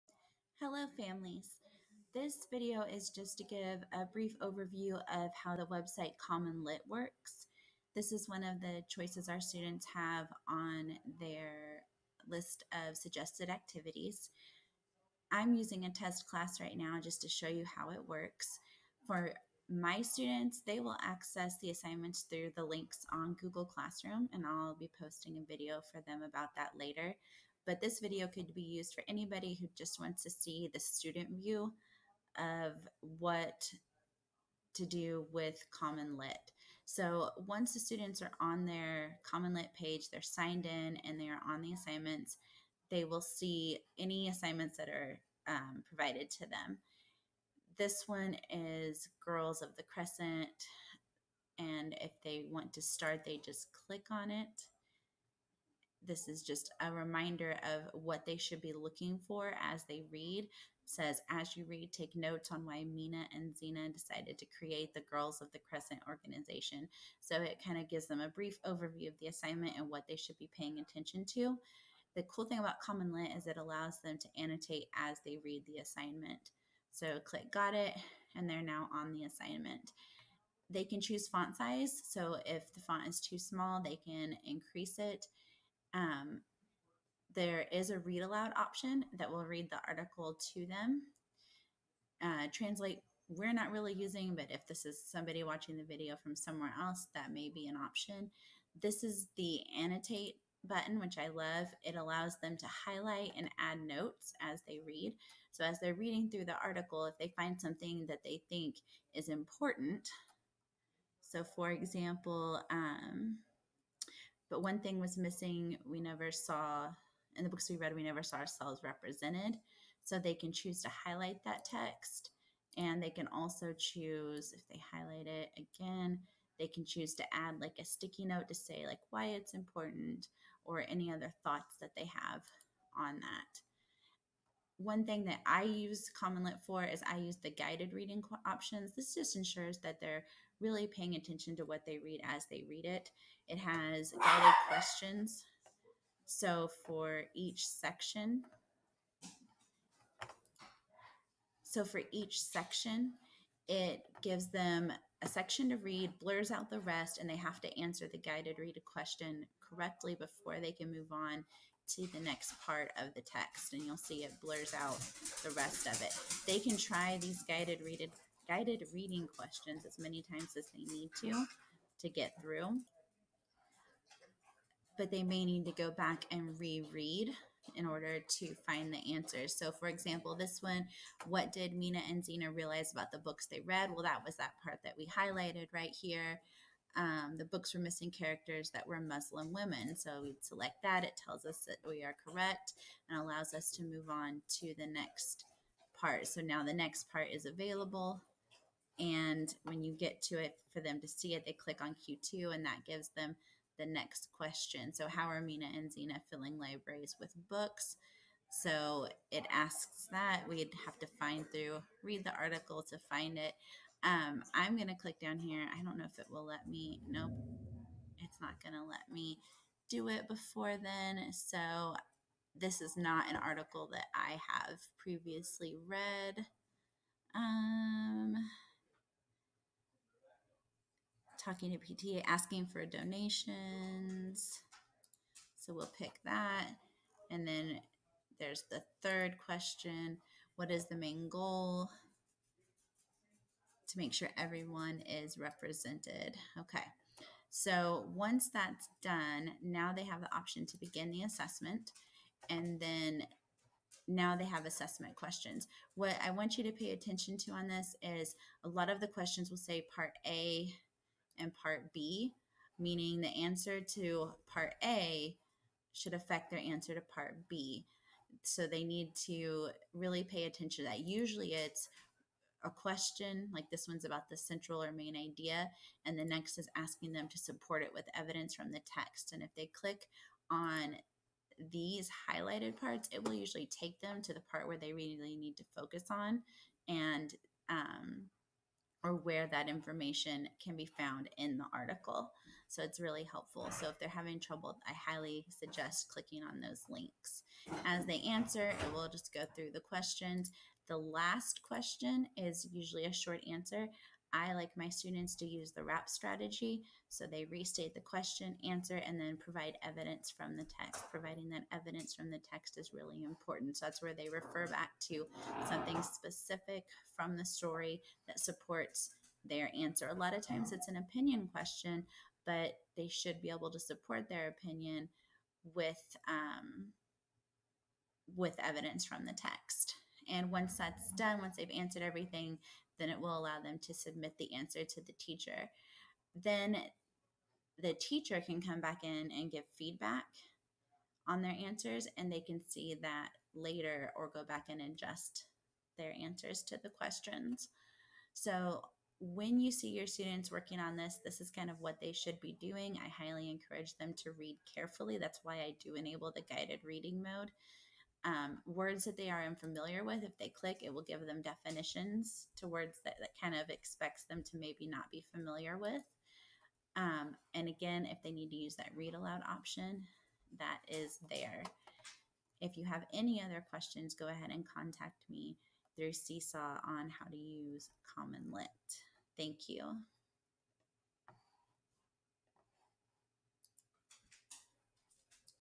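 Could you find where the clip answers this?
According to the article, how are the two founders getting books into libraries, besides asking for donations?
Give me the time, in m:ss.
3:51.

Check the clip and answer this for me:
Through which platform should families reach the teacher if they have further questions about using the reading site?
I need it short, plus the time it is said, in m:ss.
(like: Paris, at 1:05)
Seesaw, at 6:16.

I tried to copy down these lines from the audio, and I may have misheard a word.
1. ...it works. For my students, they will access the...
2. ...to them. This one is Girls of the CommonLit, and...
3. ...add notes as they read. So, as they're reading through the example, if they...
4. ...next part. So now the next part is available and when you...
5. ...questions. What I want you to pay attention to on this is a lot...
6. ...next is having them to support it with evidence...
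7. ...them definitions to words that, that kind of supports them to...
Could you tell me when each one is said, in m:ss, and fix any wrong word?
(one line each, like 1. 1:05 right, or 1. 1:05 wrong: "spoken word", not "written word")
1. 0:17 right
2. 0:46 wrong: "Crescent", not "CommonLit"
3. 1:43 wrong: "article", not "example"
4. 3:14 right
5. 4:15 right
6. 4:36 wrong: "asking", not "having"
7. 6:01 wrong: "expects", not "supports".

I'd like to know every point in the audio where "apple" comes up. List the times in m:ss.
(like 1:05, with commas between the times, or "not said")
not said.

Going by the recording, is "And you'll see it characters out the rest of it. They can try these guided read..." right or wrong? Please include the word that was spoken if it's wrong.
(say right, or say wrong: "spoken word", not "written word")
wrong: "blurs", not "characters".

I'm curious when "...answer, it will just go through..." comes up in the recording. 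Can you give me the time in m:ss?
4:58.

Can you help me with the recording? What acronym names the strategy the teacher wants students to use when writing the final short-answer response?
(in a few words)
RAP.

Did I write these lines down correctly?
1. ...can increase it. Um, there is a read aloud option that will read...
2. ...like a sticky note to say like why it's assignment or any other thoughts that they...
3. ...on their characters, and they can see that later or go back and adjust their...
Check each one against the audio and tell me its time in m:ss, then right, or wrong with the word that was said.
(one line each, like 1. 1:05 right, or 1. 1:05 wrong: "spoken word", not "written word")
1. 1:24 right
2. 2:07 wrong: "important", not "assignment"
3. 5:41 wrong: "answers", not "characters".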